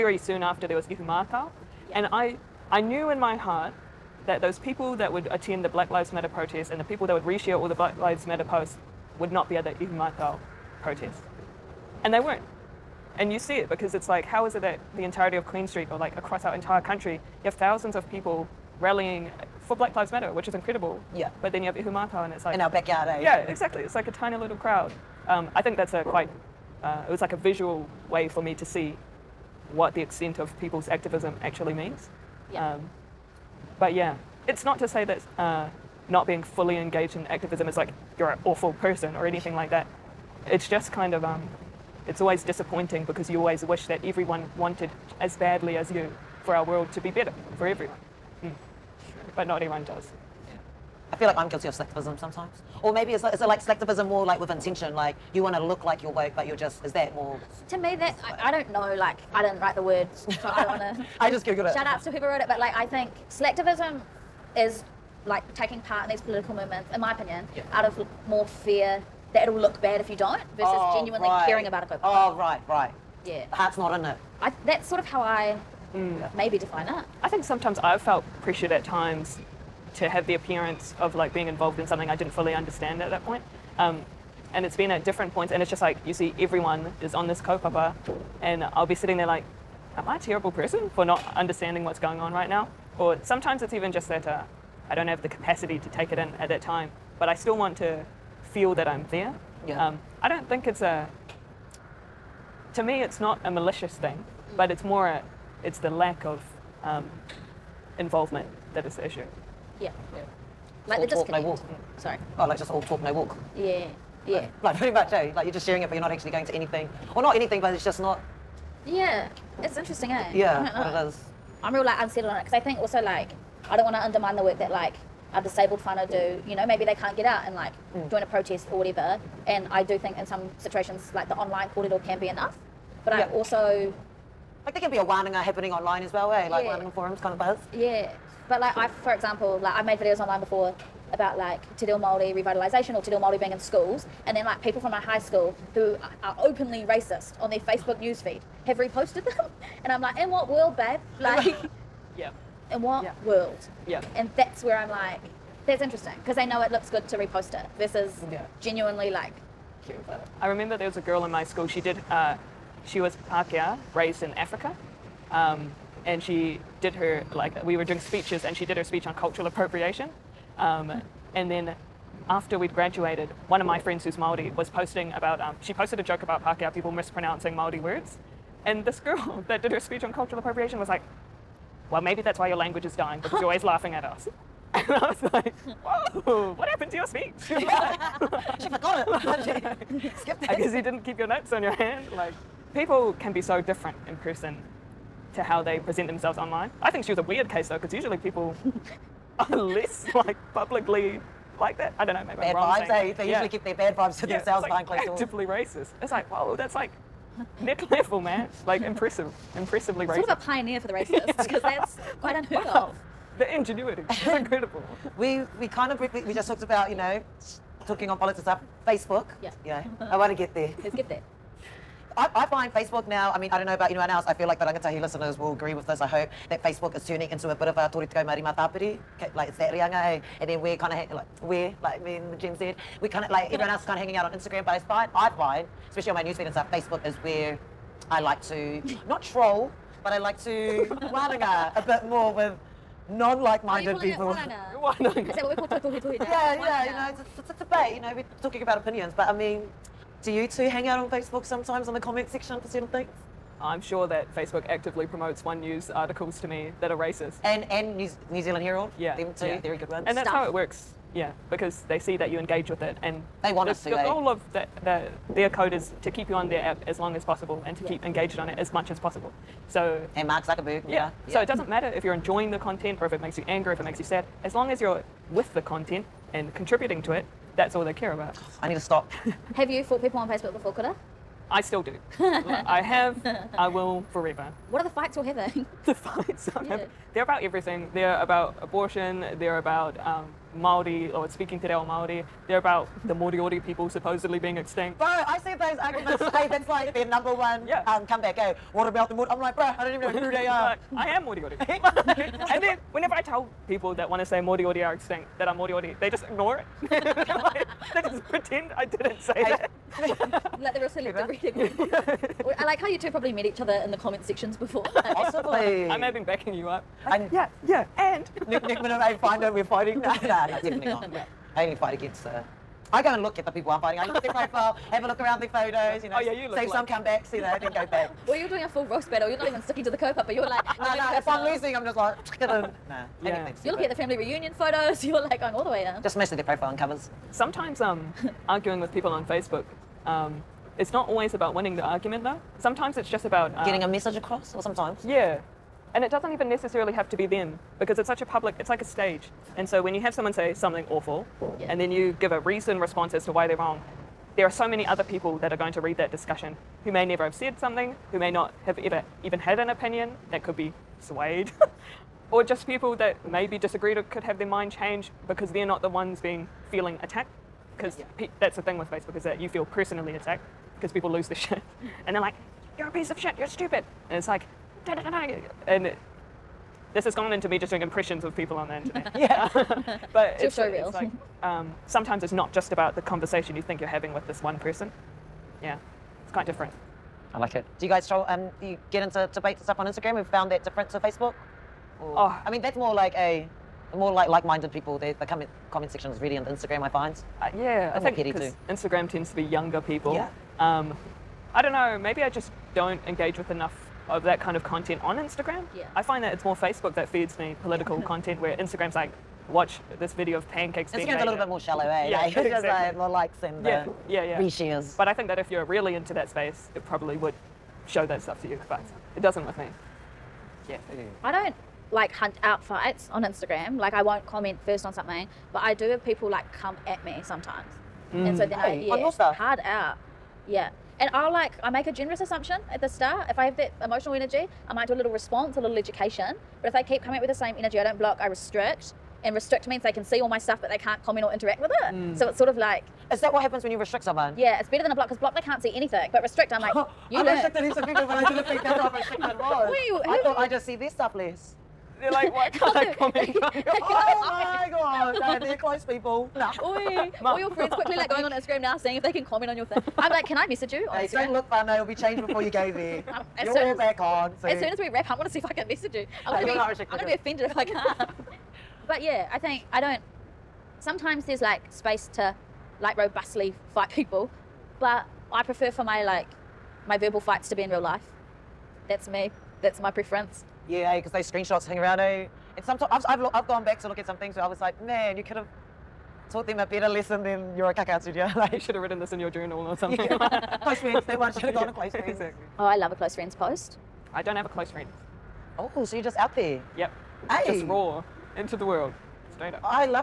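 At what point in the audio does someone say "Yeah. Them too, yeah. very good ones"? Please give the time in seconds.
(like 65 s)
258 s.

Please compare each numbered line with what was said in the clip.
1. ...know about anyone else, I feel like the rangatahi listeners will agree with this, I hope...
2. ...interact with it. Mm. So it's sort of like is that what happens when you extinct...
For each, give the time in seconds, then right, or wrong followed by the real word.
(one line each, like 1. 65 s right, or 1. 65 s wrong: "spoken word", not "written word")
1. 223 s right
2. 441 s wrong: "restrict", not "extinct".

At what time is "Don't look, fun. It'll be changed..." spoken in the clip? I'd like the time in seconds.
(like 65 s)
461 s.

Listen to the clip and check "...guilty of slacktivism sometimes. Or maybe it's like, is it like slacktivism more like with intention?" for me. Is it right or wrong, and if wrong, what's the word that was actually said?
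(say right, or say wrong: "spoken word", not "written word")
right.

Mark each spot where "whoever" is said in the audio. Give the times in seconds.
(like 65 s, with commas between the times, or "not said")
62 s.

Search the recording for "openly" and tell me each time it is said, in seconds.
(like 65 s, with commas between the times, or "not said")
146 s.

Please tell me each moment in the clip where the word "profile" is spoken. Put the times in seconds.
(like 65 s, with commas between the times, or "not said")
324 s, 336 s.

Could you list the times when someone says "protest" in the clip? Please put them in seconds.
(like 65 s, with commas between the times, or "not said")
6 s, 10 s, 128 s.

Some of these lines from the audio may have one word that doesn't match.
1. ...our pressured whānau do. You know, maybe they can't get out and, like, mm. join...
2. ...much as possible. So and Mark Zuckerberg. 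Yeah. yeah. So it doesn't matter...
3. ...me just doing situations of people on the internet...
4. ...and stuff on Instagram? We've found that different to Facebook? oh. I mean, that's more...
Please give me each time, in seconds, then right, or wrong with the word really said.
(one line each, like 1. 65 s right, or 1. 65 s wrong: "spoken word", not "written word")
1. 125 s wrong: "disabled", not "pressured"
2. 268 s right
3. 377 s wrong: "impressions", not "situations"
4. 389 s right.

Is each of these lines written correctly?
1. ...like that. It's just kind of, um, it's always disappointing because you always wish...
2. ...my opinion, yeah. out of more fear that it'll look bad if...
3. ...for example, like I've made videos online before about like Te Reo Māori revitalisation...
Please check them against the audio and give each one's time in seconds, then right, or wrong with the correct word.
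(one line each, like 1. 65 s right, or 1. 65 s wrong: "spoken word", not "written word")
1. 39 s right
2. 66 s right
3. 139 s right.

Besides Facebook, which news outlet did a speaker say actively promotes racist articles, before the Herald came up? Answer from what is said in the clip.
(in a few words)
One News.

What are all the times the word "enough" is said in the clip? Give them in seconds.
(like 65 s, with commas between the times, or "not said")
132 s, 403 s.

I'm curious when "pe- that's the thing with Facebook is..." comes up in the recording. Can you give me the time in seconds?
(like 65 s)
368 s.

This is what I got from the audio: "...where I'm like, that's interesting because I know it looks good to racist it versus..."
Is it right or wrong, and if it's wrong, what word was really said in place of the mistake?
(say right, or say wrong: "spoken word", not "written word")
wrong: "repost", not "racist".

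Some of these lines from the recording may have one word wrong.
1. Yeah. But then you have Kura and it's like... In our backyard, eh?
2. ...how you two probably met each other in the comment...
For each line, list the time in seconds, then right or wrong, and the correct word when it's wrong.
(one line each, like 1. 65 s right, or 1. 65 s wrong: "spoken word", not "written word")
1. 21 s wrong: "Ihumātao", not "Kura"
2. 312 s right.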